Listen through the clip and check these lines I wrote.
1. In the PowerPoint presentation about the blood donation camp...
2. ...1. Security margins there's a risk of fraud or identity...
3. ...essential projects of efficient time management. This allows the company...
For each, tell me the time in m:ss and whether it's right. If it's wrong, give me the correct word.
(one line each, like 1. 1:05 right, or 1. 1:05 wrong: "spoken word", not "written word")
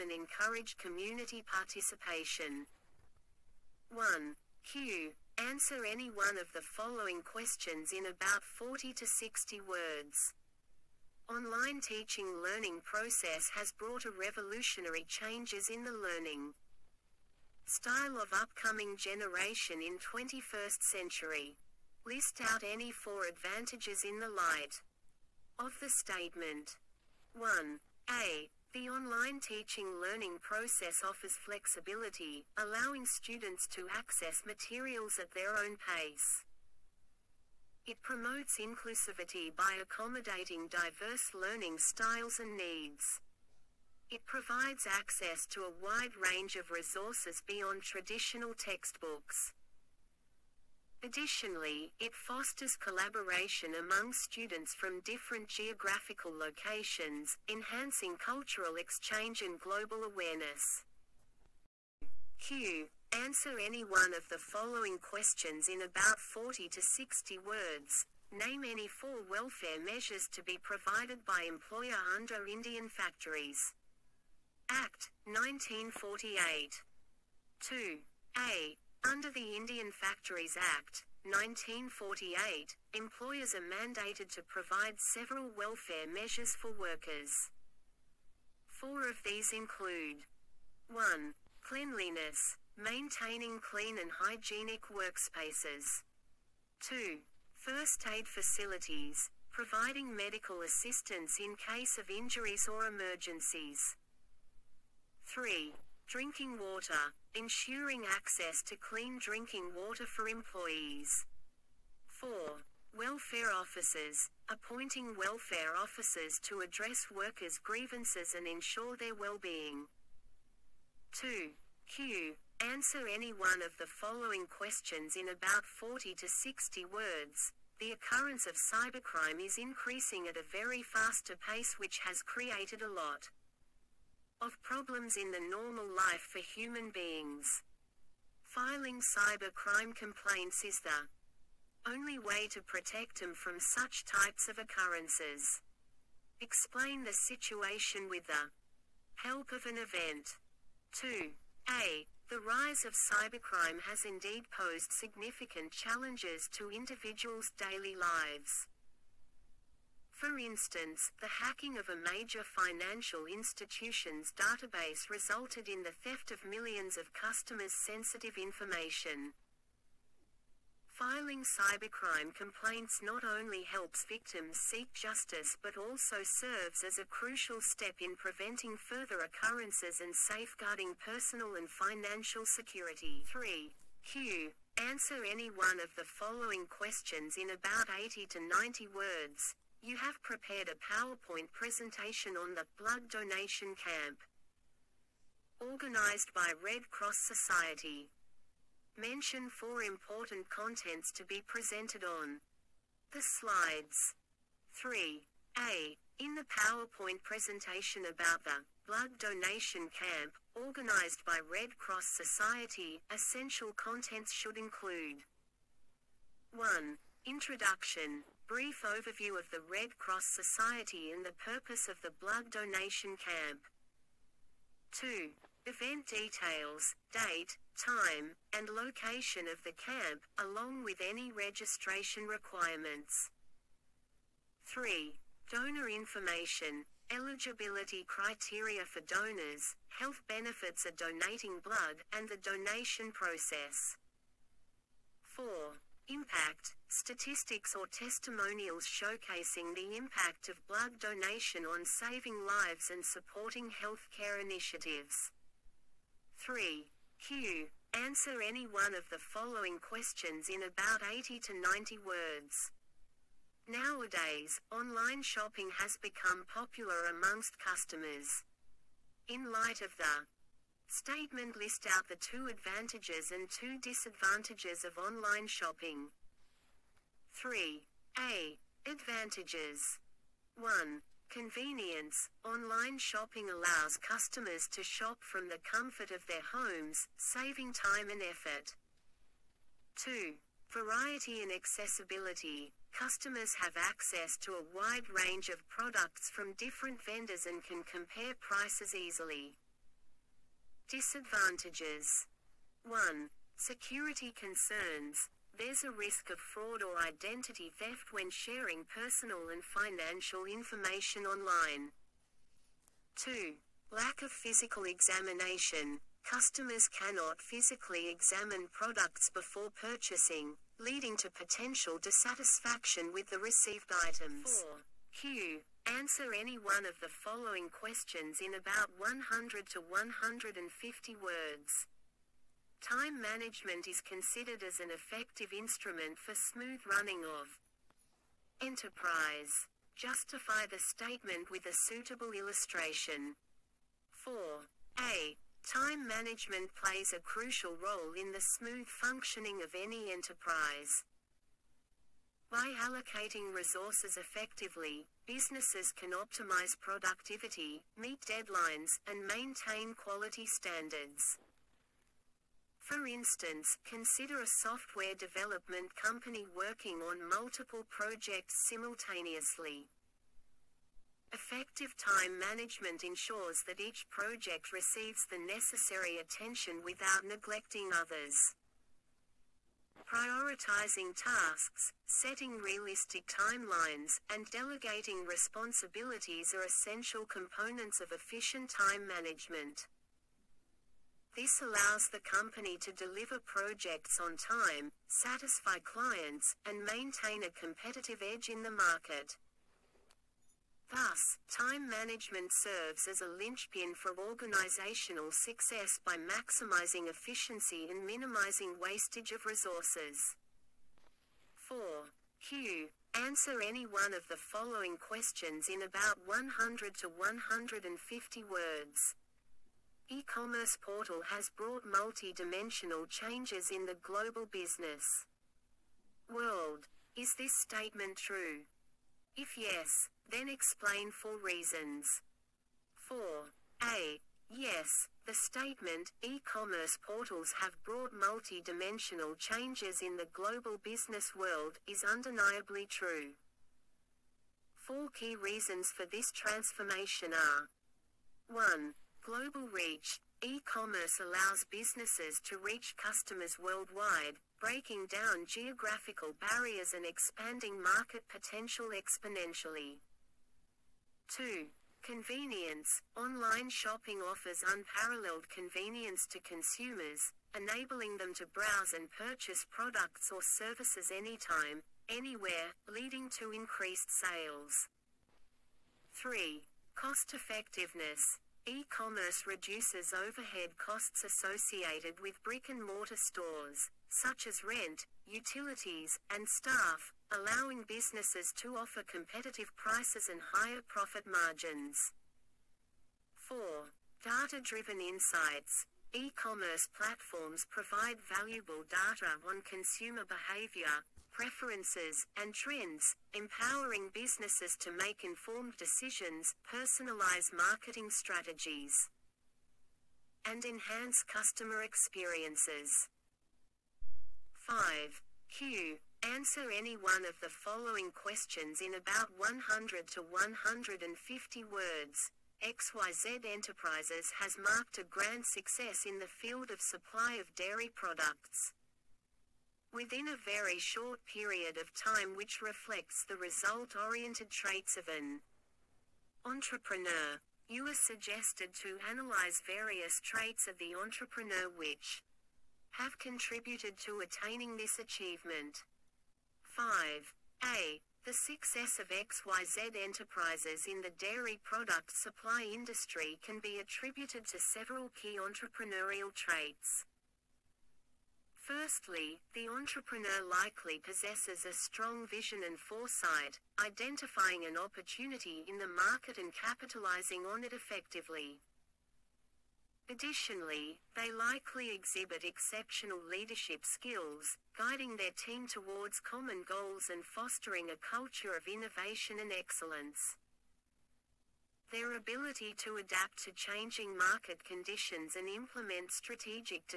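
1. 3:26 right
2. 5:02 wrong: "concerns", not "margins"
3. 6:26 wrong: "components", not "projects".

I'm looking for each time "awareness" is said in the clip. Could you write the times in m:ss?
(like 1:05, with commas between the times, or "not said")
1:00.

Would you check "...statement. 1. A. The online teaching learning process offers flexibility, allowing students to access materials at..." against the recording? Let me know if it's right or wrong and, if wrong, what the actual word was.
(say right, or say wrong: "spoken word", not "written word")
right.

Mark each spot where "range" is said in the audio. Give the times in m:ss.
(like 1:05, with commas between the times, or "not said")
0:46, 4:55.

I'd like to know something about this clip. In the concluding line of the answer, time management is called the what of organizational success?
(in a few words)
Linchpin.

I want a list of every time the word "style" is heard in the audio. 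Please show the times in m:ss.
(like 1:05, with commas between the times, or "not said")
0:17, 0:41.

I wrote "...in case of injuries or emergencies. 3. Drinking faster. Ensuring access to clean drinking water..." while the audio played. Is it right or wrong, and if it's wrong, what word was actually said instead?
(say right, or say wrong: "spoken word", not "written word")
wrong: "water", not "faster".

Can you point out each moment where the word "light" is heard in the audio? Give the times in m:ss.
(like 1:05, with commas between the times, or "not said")
0:24, 4:29.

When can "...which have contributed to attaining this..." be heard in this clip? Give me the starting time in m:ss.
9:01.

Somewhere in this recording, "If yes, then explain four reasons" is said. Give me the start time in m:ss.
7:09.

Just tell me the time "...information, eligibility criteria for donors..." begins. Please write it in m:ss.
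3:55.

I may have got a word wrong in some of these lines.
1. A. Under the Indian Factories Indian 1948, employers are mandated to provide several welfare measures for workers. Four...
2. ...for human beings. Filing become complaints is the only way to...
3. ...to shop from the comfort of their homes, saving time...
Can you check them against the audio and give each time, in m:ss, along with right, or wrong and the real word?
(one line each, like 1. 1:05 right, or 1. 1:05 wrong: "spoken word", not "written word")
1. 1:18 wrong: "Act", not "Indian"
2. 2:16 wrong: "cybercrime", not "become"
3. 4:44 right.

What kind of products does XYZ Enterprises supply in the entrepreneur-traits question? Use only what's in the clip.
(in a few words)
Dairy products.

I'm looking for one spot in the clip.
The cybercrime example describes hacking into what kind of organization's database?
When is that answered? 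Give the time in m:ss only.
2:41.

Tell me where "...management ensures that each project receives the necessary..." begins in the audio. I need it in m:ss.
6:12.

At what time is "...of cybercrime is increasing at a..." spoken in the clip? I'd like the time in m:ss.
2:08.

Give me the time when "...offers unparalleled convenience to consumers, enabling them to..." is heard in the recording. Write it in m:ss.
7:44.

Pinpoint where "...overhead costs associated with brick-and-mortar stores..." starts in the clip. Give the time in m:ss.
8:00.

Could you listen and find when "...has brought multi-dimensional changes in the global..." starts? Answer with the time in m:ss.
7:01.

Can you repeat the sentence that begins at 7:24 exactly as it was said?
Four key reasons for this transformation are 1.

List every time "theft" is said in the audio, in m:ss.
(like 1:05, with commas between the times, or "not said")
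2:45, 5:07.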